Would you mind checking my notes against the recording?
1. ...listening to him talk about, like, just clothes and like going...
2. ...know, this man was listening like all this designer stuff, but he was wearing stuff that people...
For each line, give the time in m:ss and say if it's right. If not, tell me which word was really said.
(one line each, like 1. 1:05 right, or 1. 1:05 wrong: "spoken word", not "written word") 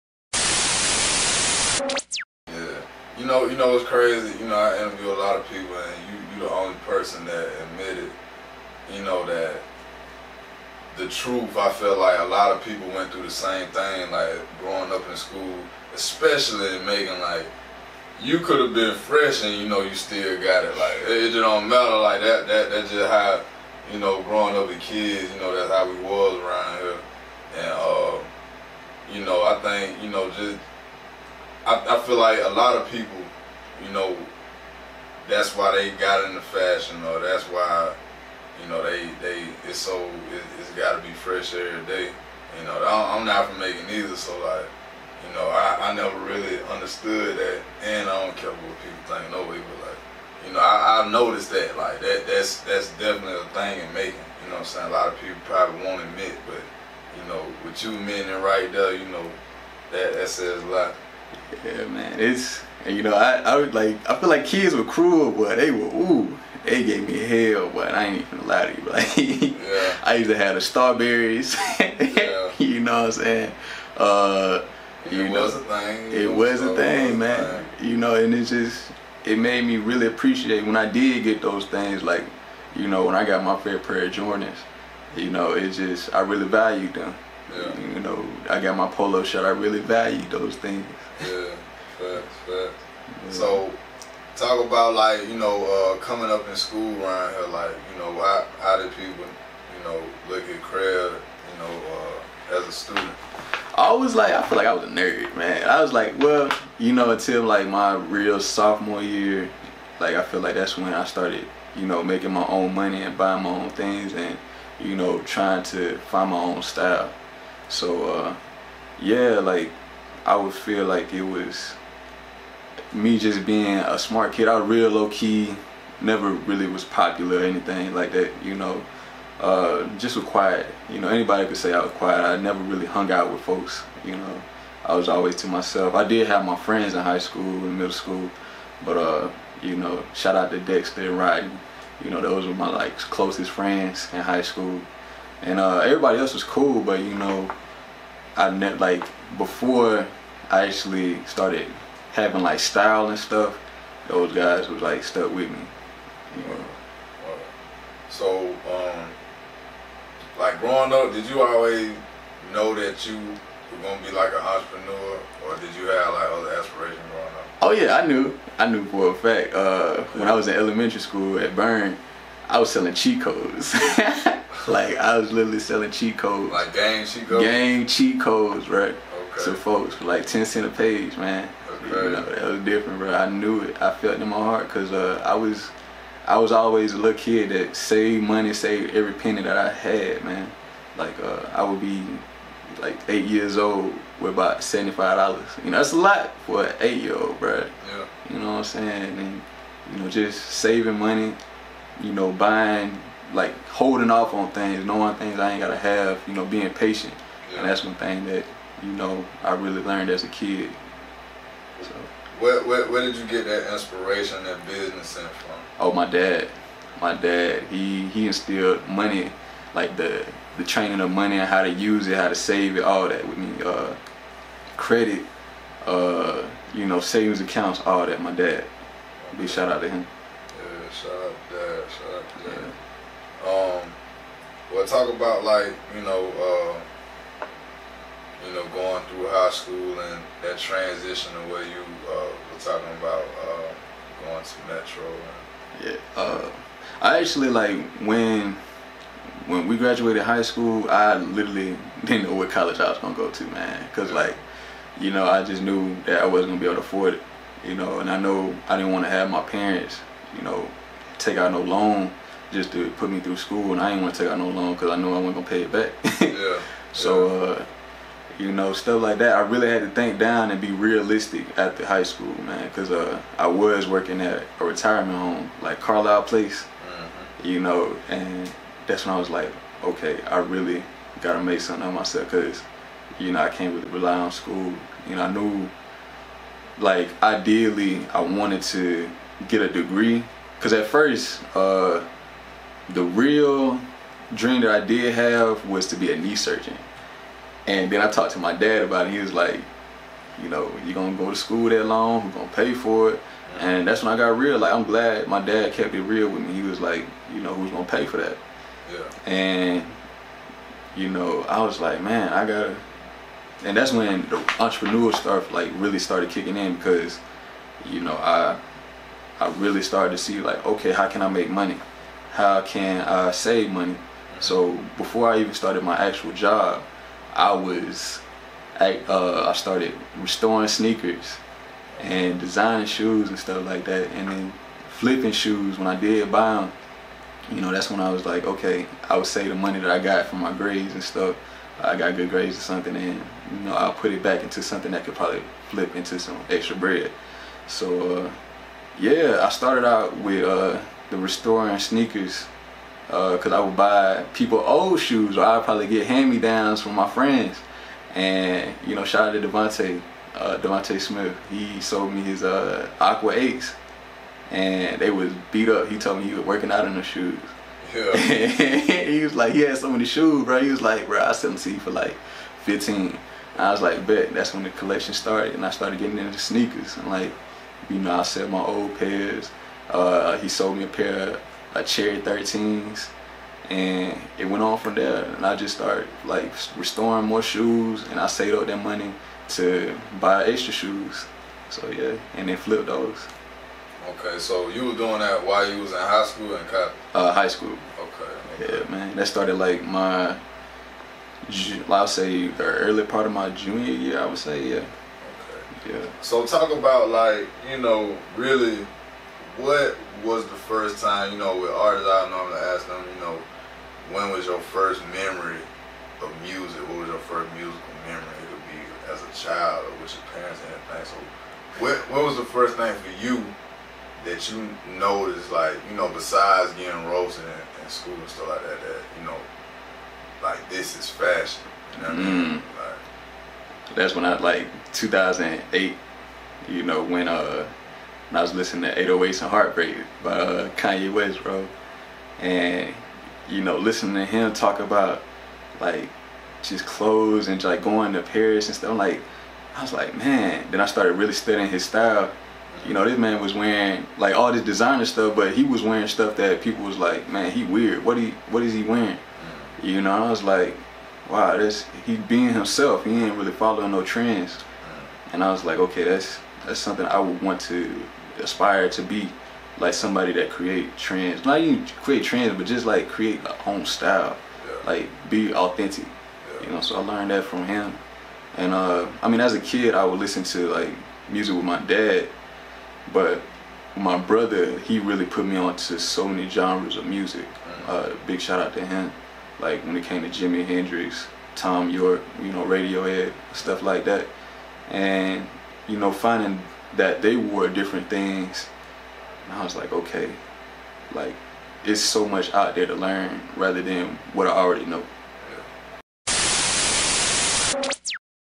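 1. 7:23 right
2. 7:32 wrong: "wearing", not "listening".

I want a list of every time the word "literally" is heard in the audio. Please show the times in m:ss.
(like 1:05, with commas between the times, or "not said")
2:55, 4:11.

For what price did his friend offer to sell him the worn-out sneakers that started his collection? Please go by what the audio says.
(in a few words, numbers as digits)
$15.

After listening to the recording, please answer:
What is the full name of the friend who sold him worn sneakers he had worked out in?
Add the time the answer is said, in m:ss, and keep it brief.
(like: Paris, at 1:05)
Devontae Smith, at 6:00.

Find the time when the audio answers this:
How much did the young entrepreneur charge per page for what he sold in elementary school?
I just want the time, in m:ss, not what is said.
3:00.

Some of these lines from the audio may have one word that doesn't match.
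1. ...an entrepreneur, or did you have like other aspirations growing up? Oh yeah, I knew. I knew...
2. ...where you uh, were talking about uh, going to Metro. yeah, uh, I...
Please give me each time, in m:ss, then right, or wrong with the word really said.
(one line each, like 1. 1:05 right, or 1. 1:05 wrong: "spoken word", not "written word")
1. 2:44 right
2. 4:01 right.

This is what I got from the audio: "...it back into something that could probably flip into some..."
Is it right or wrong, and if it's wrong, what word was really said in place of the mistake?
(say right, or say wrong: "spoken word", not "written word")
right.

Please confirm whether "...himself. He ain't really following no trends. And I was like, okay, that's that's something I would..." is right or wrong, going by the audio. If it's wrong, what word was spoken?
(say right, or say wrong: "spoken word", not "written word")
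right.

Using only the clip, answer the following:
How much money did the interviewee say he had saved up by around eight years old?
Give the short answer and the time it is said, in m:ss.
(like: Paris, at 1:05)
$75, at 3:14.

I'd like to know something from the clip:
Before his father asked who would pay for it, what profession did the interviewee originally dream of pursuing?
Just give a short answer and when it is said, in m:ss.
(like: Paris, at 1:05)
Knee surgeon, at 4:56.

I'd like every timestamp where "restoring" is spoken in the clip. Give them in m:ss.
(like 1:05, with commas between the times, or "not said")
5:30, 5:51, 6:26.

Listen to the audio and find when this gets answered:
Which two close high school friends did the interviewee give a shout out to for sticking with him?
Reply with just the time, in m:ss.
2:20.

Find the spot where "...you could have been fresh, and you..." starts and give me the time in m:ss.
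0:18.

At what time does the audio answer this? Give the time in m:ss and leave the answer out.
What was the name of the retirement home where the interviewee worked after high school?
4:35.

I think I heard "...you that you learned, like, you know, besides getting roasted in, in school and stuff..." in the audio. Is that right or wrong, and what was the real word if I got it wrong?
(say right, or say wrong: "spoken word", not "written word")
wrong: "noticed", not "learned".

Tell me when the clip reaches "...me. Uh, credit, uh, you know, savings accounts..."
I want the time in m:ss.
3:43.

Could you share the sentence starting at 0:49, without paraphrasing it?
No way, but like, you know, I, I've noticed that.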